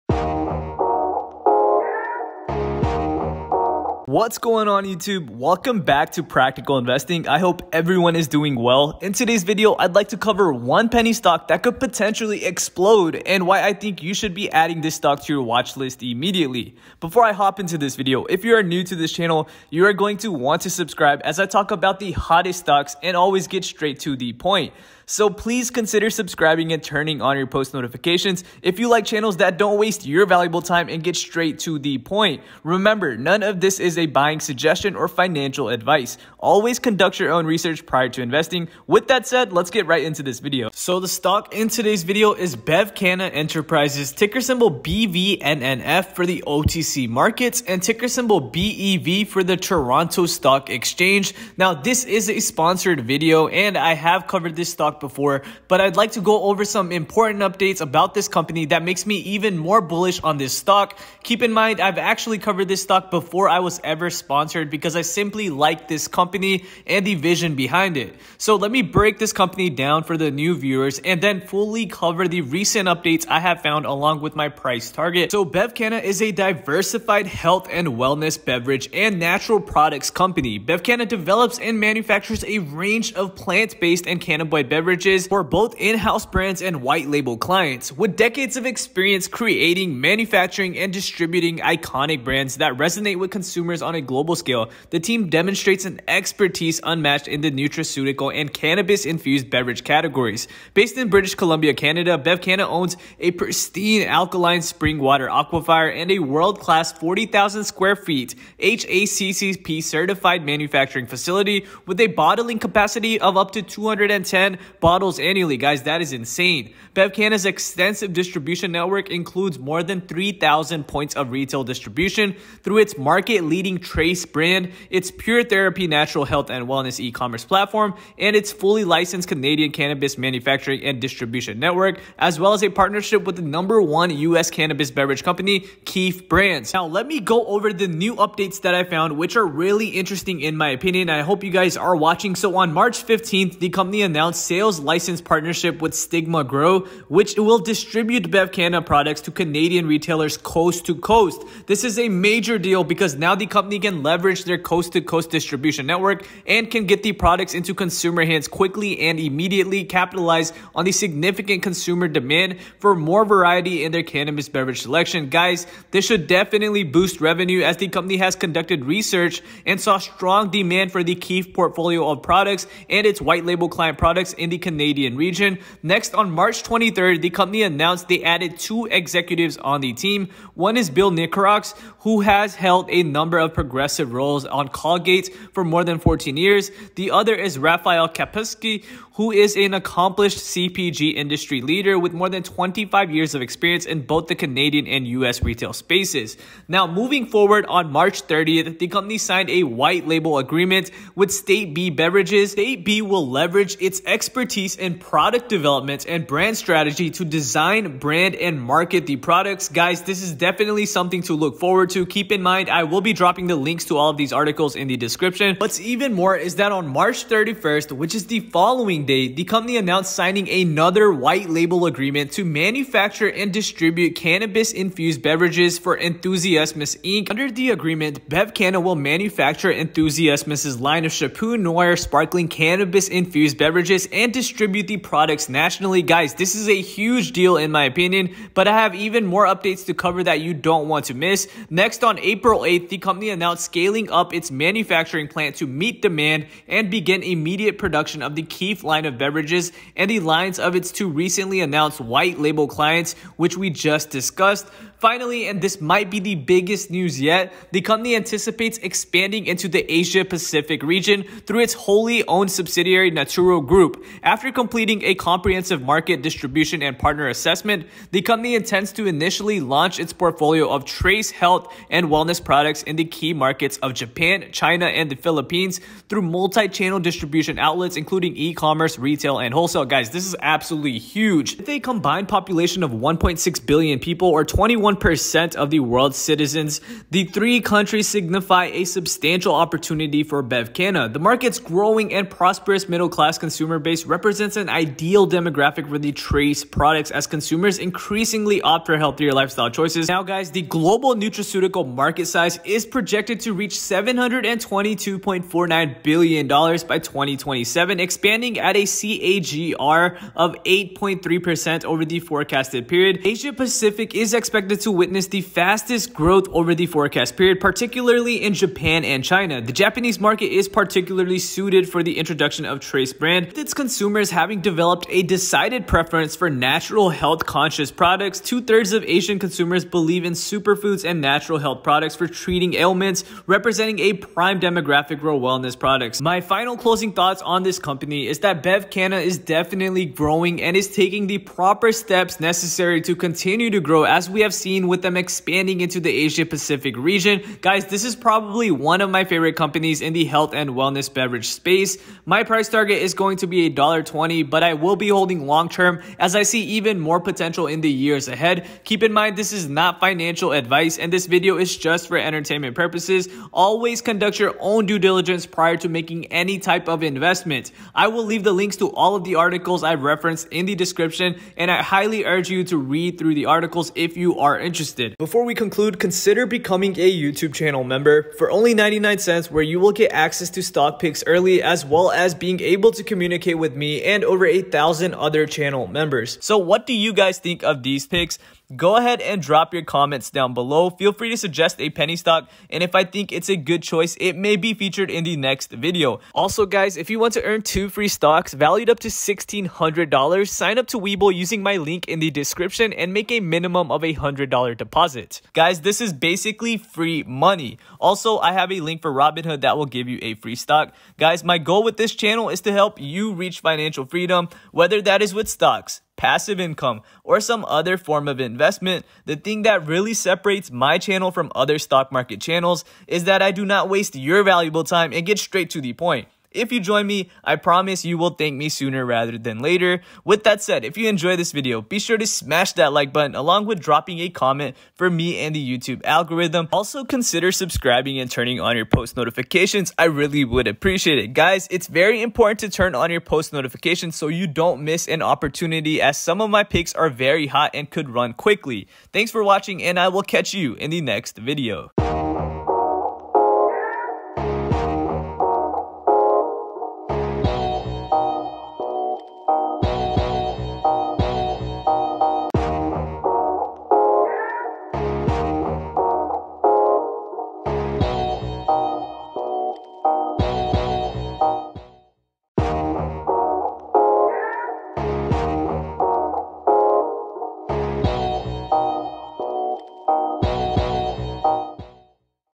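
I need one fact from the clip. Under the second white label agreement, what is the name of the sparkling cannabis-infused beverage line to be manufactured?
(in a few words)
Chapeau Noir.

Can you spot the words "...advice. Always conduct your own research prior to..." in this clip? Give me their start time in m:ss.
0:35.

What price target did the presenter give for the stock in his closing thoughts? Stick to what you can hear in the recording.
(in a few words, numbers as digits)
$1.20.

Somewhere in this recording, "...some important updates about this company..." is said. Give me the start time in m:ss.
0:56.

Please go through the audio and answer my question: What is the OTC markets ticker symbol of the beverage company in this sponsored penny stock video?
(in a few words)
BVNNF.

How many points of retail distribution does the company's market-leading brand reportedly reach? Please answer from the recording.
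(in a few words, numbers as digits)
3,000.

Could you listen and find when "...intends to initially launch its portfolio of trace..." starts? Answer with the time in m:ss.
4:28.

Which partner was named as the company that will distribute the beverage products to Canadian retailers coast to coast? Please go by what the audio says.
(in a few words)
Stigma Grow.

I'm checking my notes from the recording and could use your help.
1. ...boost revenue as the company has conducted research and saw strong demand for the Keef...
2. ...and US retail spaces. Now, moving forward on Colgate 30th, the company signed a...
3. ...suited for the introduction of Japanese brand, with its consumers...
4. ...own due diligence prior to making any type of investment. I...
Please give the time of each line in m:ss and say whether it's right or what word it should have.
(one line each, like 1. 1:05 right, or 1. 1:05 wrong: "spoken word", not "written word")
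1. 2:46 right
2. 3:14 wrong: "March", not "Colgate"
3. 5:21 wrong: "Trace", not "Japanese"
4. 6:04 right.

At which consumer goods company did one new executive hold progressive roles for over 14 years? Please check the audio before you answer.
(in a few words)
Colgate.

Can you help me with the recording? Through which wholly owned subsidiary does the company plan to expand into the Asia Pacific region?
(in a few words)
Naturo Group.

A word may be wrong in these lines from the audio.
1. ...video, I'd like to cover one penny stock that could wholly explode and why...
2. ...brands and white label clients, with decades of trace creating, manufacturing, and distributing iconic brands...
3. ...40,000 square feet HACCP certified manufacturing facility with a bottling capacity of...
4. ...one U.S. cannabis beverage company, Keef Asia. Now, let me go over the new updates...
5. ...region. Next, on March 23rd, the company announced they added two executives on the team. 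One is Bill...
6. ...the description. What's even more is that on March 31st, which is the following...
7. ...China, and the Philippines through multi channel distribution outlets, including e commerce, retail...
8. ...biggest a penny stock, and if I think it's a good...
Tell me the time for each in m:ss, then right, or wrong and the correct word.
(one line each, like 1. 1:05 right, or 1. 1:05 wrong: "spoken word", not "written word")
1. 0:09 wrong: "potentially", not "wholly"
2. 1:26 wrong: "experience", not "trace"
3. 1:46 right
4. 2:13 wrong: "Brands", not "Asia"
5. 2:55 right
6. 3:34 right
7. 4:34 right
8. 6:31 wrong: "suggest", not "biggest".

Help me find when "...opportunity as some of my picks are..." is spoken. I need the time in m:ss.
7:25.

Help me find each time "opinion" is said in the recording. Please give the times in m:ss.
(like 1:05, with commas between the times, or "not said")
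2:20, 3:57.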